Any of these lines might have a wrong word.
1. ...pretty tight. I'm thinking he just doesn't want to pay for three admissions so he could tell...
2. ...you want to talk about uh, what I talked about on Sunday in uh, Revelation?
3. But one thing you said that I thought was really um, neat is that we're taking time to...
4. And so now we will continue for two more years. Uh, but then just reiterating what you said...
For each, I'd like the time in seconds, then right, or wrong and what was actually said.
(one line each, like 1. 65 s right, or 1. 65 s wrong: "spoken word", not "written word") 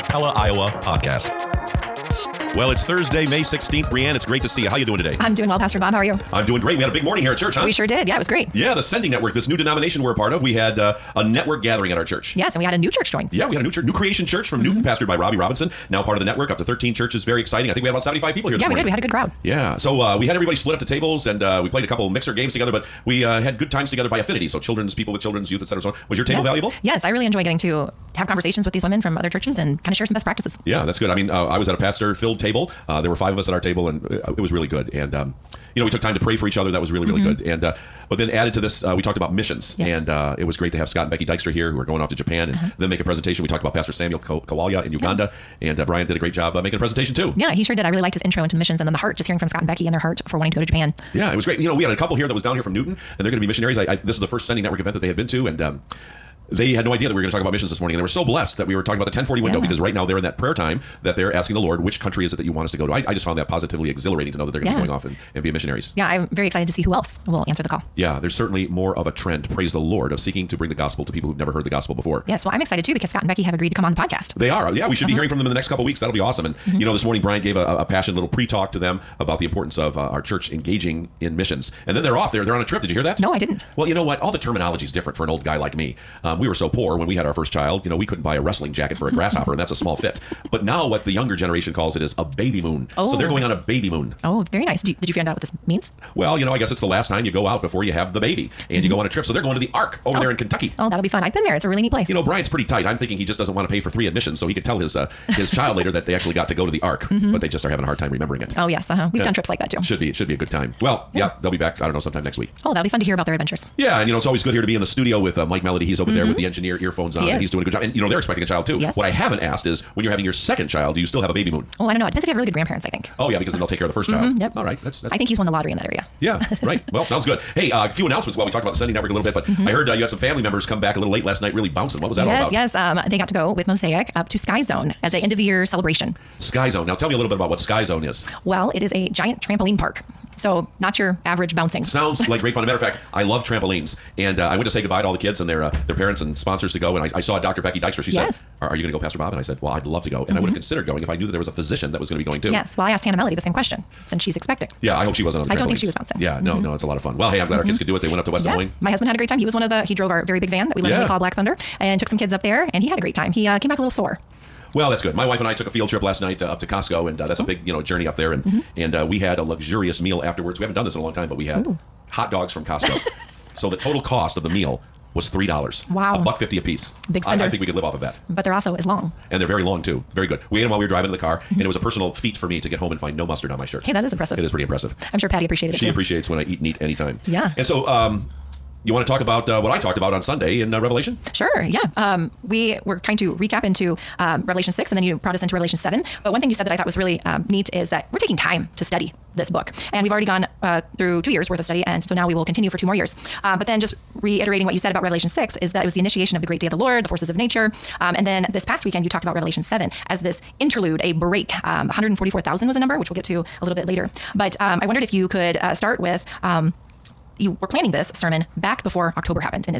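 1. 102 s right
2. 188 s right
3. 196 s right
4. 201 s right.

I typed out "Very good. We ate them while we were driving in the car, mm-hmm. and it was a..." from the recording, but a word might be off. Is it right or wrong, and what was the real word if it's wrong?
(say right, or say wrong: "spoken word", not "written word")
right.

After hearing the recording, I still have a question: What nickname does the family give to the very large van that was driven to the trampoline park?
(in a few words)
Black Thunder.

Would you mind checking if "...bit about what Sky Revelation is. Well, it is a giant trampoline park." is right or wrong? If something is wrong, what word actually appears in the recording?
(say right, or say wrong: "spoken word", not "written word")
wrong: "Zone", not "Revelation".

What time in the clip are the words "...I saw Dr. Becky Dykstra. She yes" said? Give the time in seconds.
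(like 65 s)
147 s.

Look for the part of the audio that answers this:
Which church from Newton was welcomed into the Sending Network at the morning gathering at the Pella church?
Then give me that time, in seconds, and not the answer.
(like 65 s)
13 s.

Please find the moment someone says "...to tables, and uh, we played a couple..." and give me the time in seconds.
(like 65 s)
20 s.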